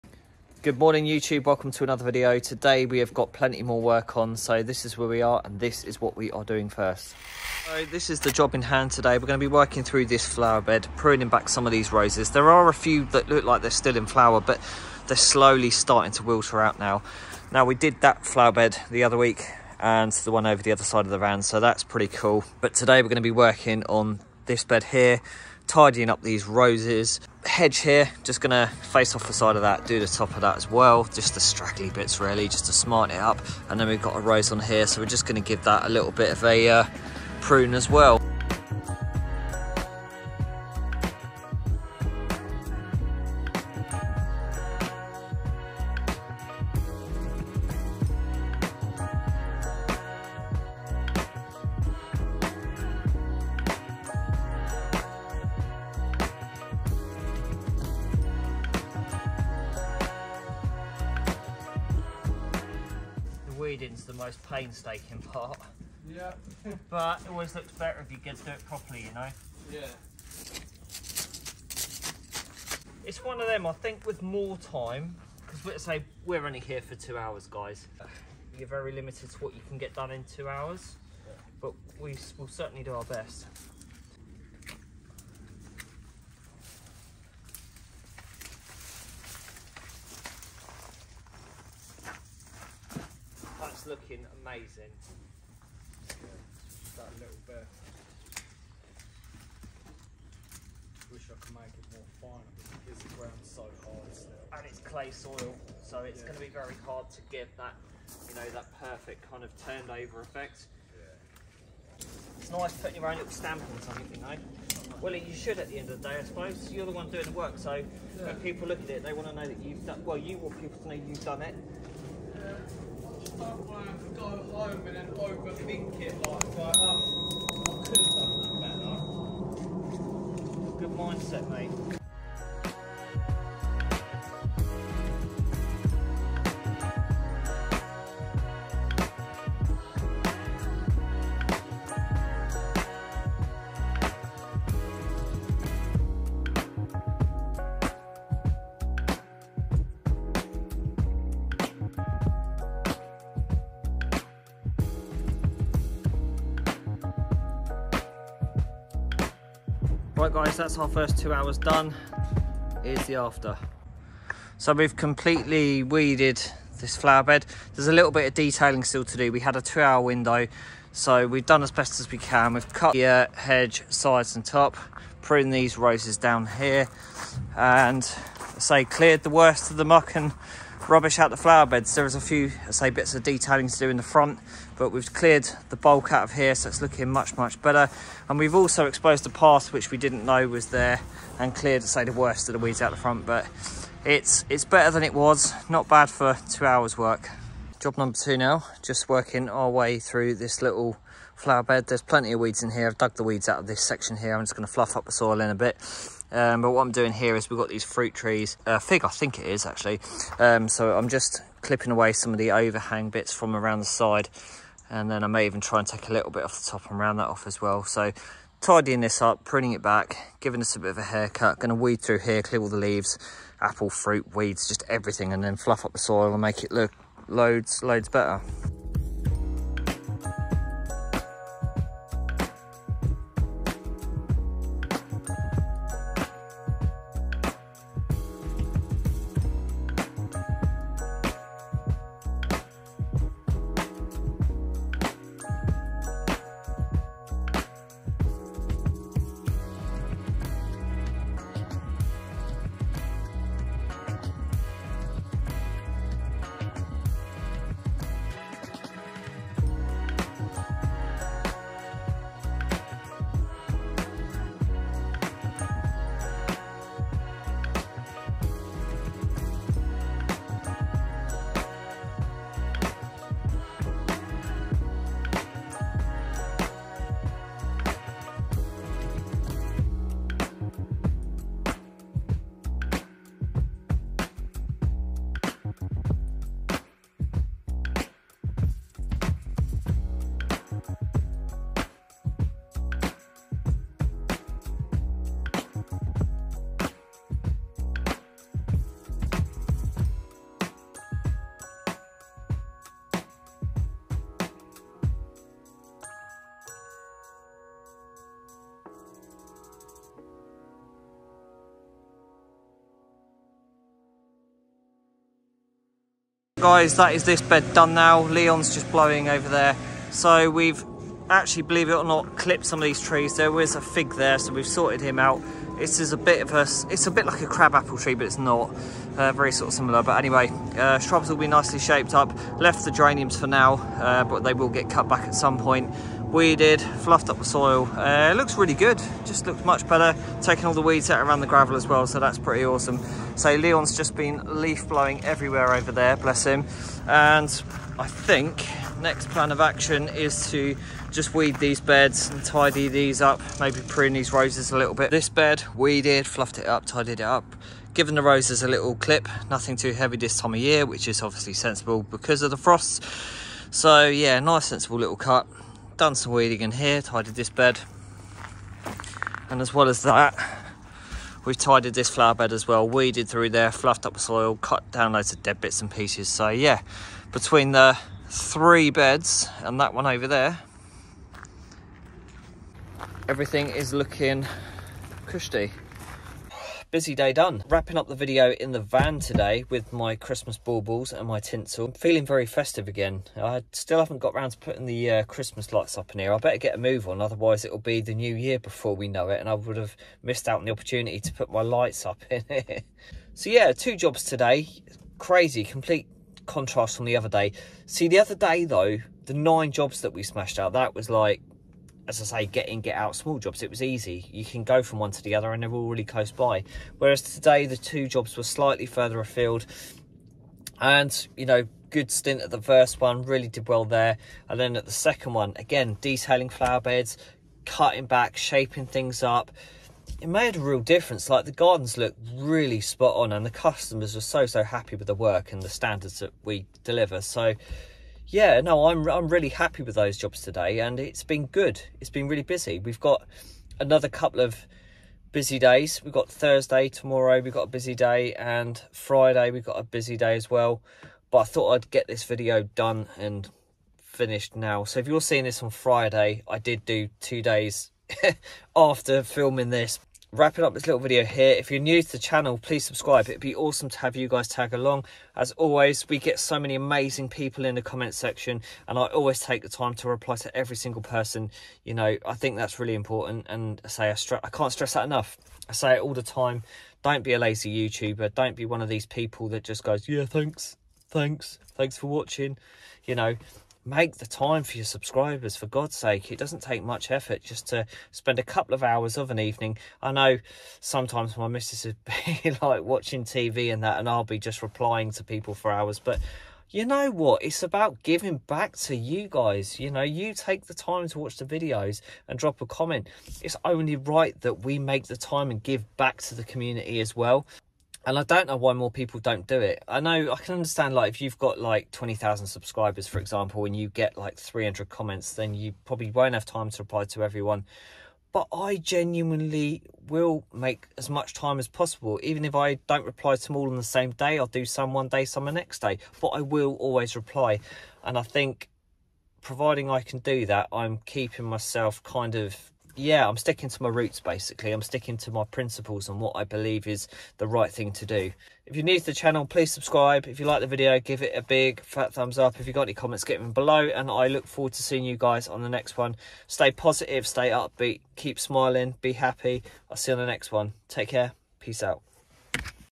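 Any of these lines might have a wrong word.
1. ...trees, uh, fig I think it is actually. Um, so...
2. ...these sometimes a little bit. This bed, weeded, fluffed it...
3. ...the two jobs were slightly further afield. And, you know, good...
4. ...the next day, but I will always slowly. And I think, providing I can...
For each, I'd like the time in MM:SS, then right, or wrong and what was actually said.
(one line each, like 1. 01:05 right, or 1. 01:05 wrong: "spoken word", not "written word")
1. 03:28 right
2. 05:54 wrong: "roses", not "sometimes"
3. 06:57 right
4. 08:45 wrong: "reply", not "slowly".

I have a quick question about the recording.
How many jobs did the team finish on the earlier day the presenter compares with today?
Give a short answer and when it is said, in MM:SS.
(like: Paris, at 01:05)
9, at 06:49.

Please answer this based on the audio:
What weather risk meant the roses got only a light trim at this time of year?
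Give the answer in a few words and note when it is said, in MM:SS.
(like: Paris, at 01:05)
Frosts, at 06:02.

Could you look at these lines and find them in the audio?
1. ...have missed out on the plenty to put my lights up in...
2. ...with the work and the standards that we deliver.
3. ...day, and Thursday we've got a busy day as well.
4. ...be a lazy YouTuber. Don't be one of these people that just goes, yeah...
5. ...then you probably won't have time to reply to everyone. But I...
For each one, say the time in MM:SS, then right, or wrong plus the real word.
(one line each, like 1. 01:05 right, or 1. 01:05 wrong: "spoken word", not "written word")
1. 06:39 wrong: "opportunity", not "plenty"
2. 07:14 right
3. 07:27 wrong: "Friday", not "Thursday"
4. 07:57 right
5. 08:35 right.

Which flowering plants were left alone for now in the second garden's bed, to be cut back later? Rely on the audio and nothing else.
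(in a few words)
Geraniums.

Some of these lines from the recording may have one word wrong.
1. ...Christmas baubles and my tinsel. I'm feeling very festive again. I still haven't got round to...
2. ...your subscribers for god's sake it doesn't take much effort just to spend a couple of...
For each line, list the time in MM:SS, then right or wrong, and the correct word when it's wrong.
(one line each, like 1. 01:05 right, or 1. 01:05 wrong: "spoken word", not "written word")
1. 06:30 right
2. 08:04 right.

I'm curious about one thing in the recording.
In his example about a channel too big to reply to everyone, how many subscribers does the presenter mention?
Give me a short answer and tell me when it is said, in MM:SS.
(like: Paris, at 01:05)
20,000, at 08:31.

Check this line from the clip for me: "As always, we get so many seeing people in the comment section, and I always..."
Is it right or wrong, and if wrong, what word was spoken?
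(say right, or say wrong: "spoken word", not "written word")
wrong: "amazing", not "seeing".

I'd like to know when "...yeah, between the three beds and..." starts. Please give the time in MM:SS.
06:16.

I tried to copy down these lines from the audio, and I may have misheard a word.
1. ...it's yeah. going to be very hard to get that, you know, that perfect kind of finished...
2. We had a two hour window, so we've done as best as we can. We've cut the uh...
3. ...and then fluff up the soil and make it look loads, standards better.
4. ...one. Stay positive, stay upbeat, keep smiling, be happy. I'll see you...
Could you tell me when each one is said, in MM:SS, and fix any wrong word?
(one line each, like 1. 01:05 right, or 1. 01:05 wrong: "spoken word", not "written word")
1. 01:46 wrong: "turned", not "finished"
2. 02:49 right
3. 03:45 wrong: "loads", not "standards"
4. 09:05 right.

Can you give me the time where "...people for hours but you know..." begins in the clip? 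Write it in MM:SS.
08:15.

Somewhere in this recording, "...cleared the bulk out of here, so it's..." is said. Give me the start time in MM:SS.
03:05.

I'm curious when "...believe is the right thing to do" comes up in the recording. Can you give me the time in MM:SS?
08:56.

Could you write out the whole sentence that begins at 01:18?
You're very limited to what you can get done in two hours, yeah.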